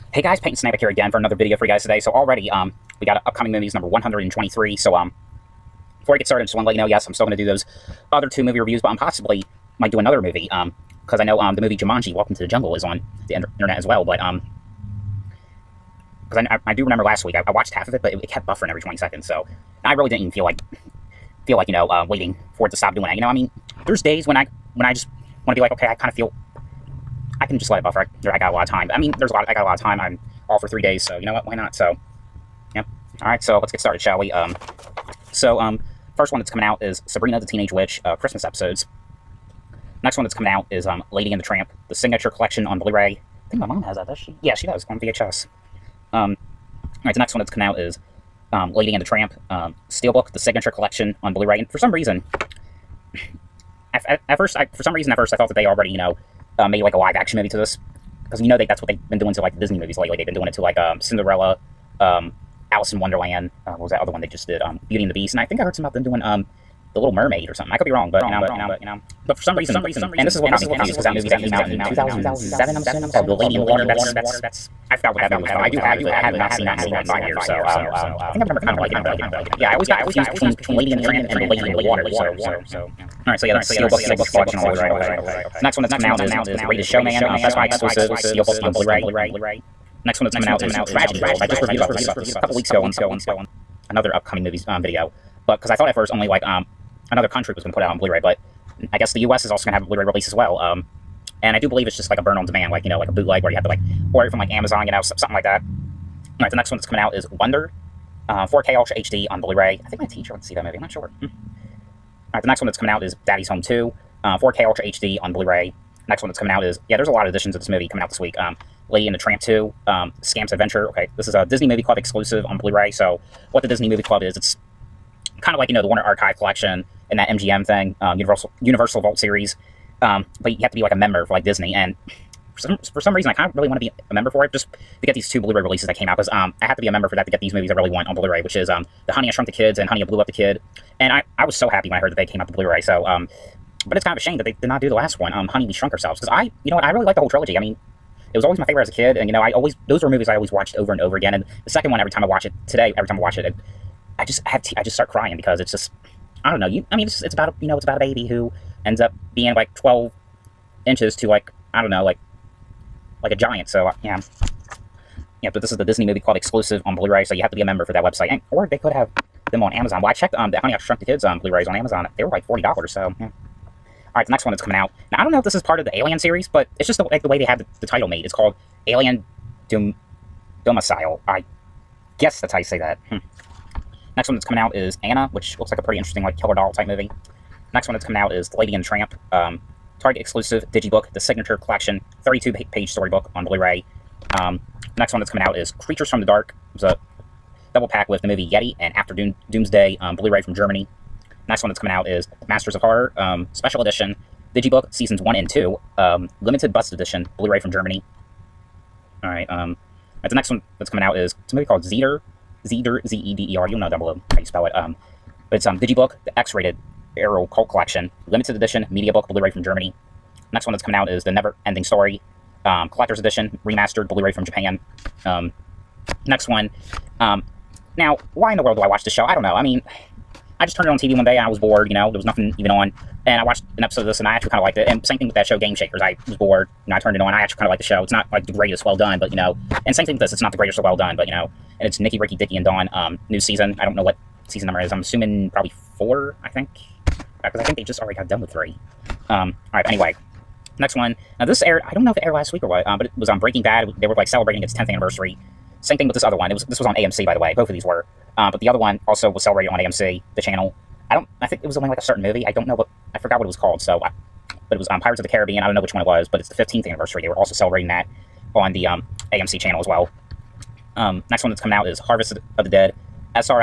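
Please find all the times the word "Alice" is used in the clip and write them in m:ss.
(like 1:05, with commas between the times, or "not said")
1:02.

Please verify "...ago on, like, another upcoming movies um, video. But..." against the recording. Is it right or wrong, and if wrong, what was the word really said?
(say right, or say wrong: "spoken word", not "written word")
right.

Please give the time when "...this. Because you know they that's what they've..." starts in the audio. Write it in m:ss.
0:57.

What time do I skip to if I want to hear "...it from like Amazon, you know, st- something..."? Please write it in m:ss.
1:44.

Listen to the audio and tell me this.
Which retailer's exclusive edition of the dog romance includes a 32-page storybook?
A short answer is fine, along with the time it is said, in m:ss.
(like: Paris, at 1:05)
Target, at 3:09.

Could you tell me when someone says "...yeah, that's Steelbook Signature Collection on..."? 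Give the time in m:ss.
1:23.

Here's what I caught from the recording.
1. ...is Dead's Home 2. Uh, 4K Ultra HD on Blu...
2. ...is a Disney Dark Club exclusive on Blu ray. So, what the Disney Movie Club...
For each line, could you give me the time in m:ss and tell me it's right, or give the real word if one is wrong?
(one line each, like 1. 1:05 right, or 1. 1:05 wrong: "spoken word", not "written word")
1. 1:53 wrong: "Daddy", not "Dead"
2. 2:01 wrong: "Movie", not "Dark".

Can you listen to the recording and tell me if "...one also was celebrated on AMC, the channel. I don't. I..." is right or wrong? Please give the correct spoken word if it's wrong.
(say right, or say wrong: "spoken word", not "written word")
right.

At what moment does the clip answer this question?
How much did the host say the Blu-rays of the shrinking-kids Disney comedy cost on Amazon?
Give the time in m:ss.
2:52.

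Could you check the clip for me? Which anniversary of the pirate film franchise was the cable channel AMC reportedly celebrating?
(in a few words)
15th.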